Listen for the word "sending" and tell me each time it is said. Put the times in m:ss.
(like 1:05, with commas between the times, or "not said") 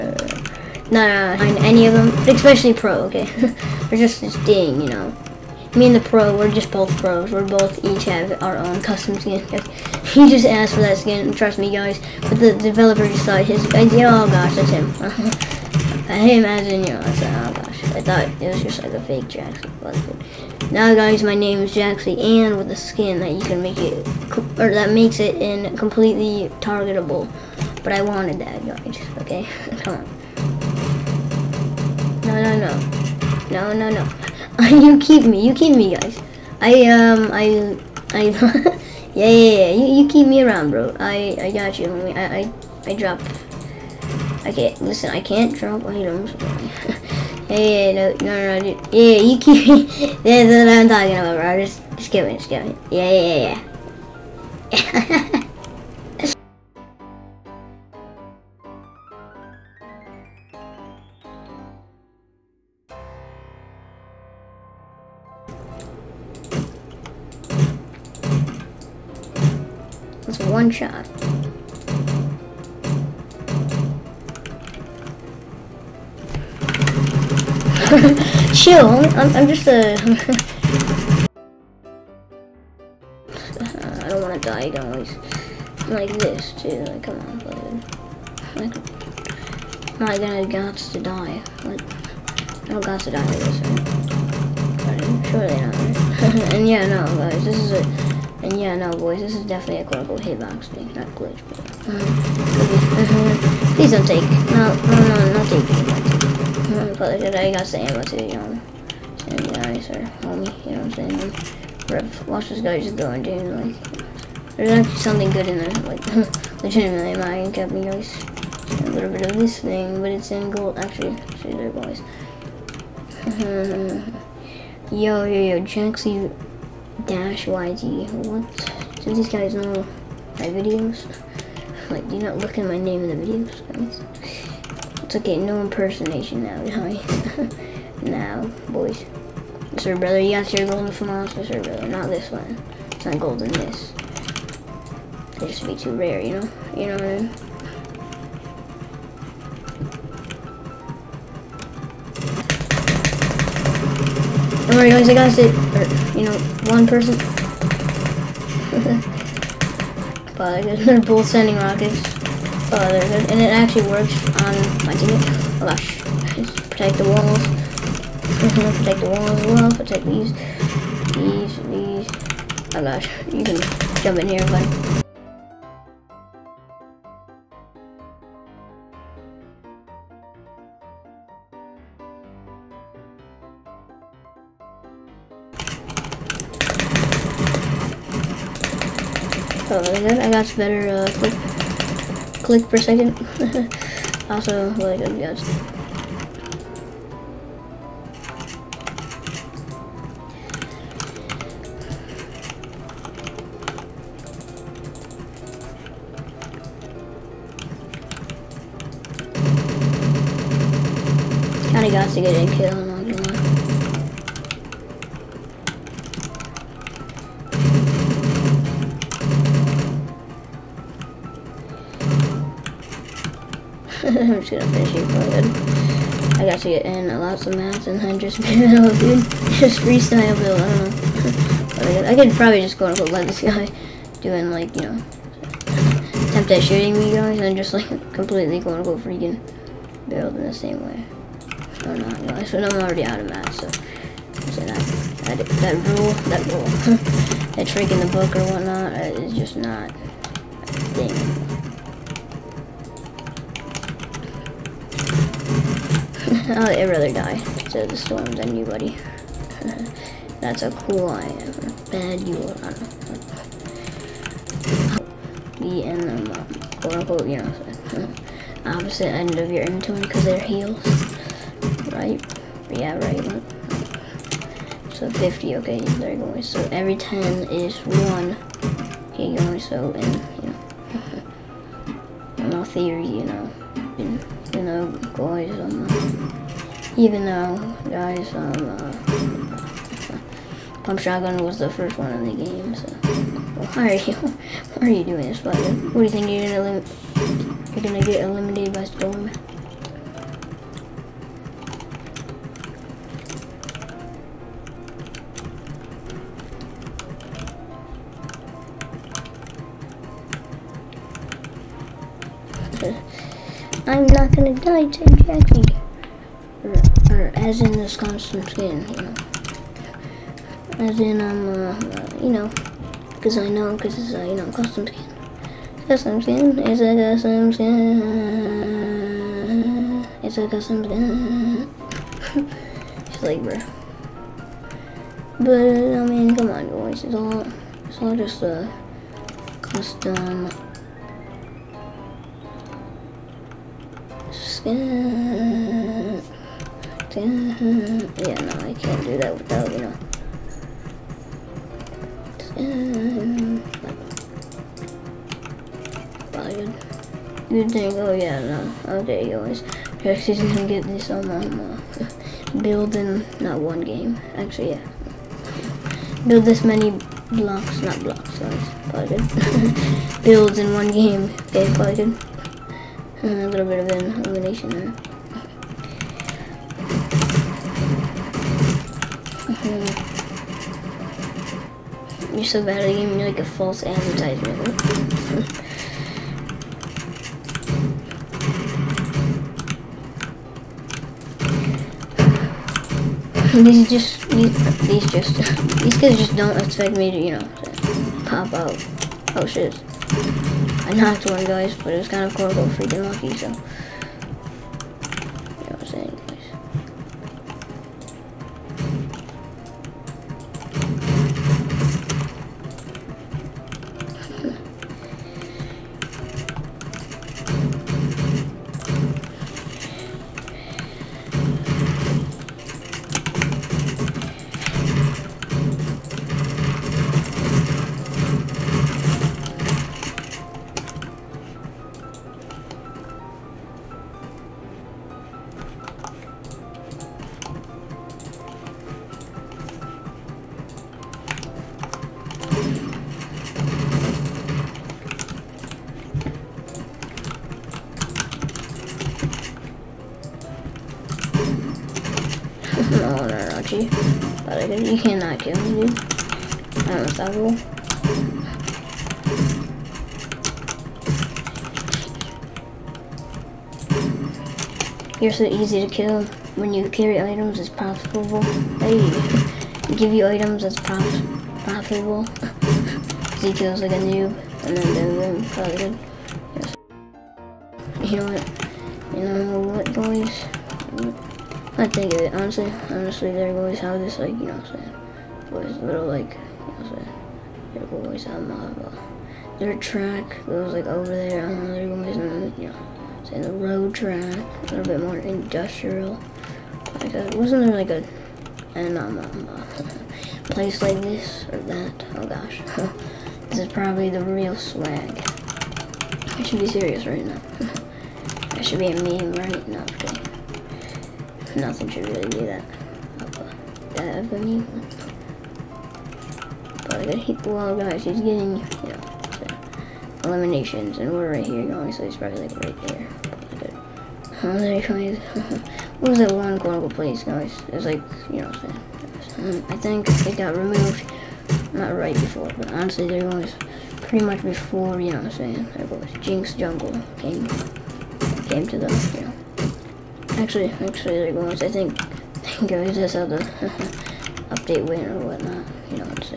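2:41.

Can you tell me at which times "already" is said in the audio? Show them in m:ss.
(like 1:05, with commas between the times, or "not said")
4:02.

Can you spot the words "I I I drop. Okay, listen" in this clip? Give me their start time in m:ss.
0:42.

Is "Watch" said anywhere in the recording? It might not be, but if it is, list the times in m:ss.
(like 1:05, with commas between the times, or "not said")
1:52.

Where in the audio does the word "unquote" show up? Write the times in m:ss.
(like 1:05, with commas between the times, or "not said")
1:40, 4:26.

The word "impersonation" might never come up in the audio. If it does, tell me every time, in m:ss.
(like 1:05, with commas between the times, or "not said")
2:15.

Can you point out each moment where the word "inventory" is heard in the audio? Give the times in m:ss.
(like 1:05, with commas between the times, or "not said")
4:29.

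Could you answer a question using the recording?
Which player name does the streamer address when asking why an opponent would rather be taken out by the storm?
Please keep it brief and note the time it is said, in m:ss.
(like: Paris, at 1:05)
Spider, at 4:55.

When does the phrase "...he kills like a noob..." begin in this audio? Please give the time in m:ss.
7:53.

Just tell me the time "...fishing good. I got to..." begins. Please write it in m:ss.
3:44.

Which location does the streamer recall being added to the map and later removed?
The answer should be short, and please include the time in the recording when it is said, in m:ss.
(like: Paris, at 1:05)
Jinx Jungle, at 8:56.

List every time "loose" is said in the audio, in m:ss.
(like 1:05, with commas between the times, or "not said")
not said.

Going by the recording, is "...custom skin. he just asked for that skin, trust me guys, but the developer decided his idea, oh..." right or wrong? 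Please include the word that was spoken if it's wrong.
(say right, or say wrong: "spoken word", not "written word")
right.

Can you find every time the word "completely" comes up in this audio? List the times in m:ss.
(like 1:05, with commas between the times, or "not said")
0:25, 3:58.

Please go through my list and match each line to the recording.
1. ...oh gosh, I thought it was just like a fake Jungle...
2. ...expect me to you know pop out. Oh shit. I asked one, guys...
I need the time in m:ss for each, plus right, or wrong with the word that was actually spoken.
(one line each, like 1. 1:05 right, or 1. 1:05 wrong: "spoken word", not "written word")
1. 0:17 wrong: "Jaxxy", not "Jungle"
2. 6:36 wrong: "knocked", not "asked".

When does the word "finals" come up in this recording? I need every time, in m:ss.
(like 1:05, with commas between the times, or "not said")
2:20.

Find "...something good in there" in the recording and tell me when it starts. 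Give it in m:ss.
1:54.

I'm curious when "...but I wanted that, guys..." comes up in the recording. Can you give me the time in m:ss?
0:27.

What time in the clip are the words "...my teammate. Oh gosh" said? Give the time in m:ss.
2:44.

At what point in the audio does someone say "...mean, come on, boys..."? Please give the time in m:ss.
5:36.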